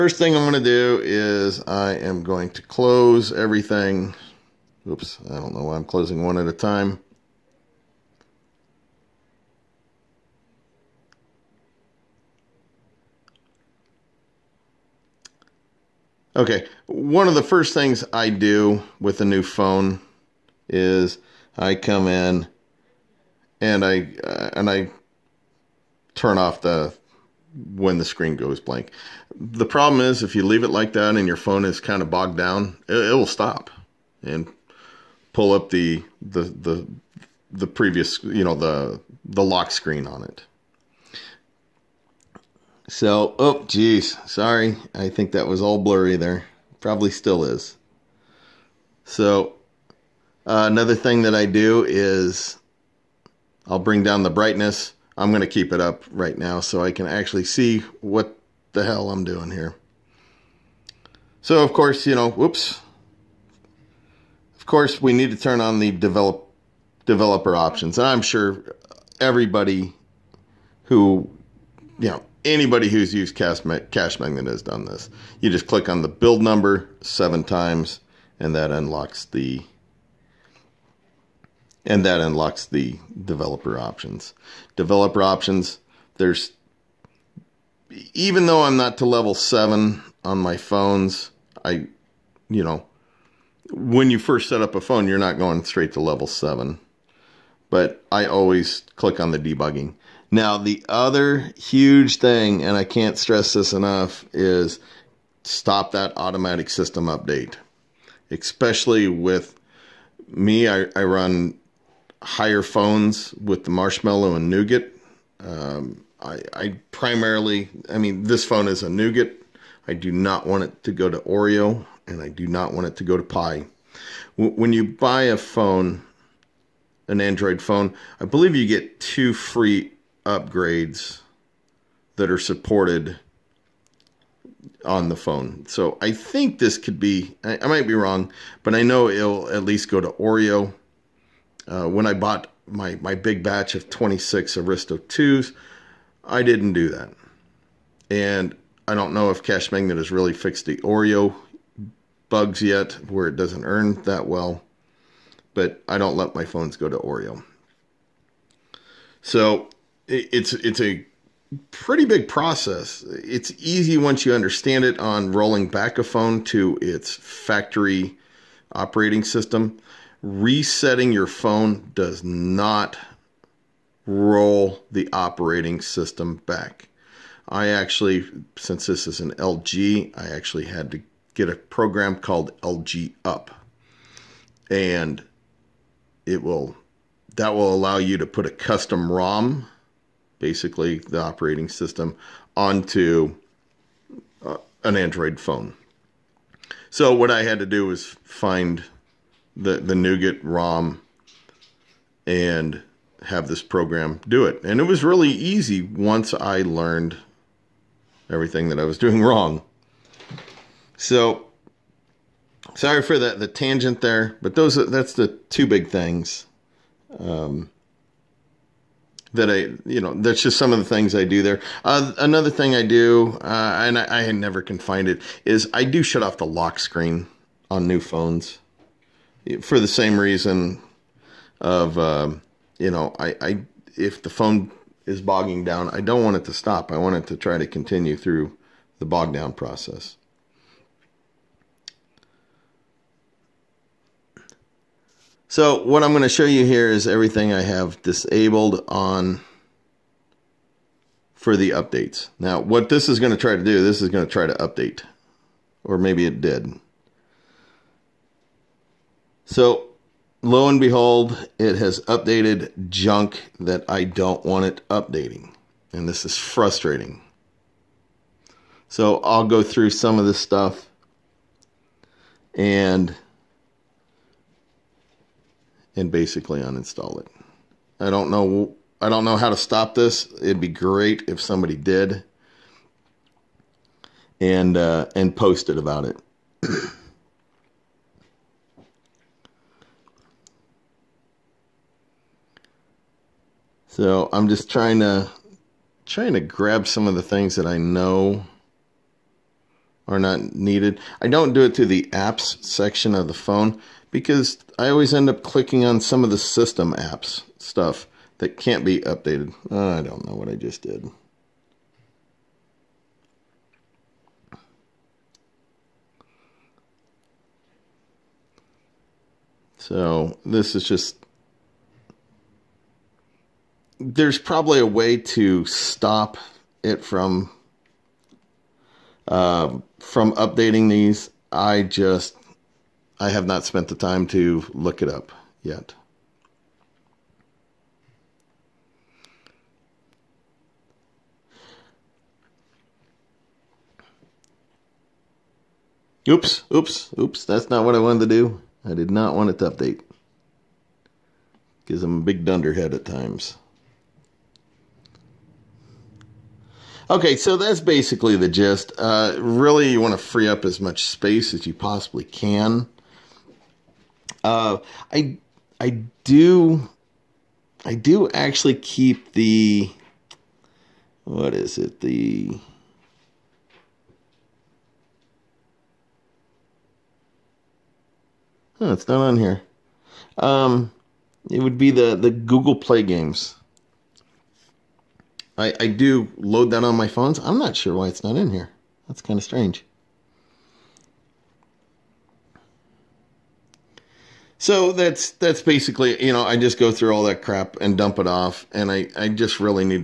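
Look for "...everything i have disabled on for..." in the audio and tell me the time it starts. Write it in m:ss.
4:07.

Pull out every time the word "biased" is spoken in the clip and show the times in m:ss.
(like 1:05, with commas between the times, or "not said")
not said.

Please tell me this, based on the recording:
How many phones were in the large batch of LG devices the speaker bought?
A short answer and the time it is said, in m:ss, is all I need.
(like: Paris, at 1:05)
26, at 2:23.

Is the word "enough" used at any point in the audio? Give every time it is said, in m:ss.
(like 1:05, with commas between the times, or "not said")
1:43.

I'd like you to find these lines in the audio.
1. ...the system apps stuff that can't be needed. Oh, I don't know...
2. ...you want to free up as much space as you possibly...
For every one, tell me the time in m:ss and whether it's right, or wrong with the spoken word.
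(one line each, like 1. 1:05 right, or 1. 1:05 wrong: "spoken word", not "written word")
1. 5:06 wrong: "updated", not "needed"
2. 5:59 right.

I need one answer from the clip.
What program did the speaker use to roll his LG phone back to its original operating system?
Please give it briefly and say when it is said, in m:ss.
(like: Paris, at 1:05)
LG Up, at 3:02.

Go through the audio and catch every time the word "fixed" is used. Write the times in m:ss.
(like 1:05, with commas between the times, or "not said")
2:30.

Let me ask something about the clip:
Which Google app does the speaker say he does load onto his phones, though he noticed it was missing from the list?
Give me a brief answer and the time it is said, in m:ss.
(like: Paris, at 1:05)
Google Play games, at 6:22.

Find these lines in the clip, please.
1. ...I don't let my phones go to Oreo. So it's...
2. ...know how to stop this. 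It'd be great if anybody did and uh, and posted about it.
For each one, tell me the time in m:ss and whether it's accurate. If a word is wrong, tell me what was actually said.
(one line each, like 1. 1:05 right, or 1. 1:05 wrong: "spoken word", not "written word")
1. 2:35 right
2. 4:39 wrong: "somebody", not "anybody".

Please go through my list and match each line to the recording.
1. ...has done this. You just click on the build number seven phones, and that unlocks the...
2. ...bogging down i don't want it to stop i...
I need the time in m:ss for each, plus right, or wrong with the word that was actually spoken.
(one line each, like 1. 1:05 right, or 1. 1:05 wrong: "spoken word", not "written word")
1. 1:14 wrong: "times", not "phones"
2. 3:55 right.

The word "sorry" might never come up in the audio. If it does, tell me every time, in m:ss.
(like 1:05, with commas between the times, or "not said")
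0:44, 3:32.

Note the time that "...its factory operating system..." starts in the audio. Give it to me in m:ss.
2:46.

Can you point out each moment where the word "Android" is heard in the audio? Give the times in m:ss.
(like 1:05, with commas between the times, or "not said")
2:07, 3:14.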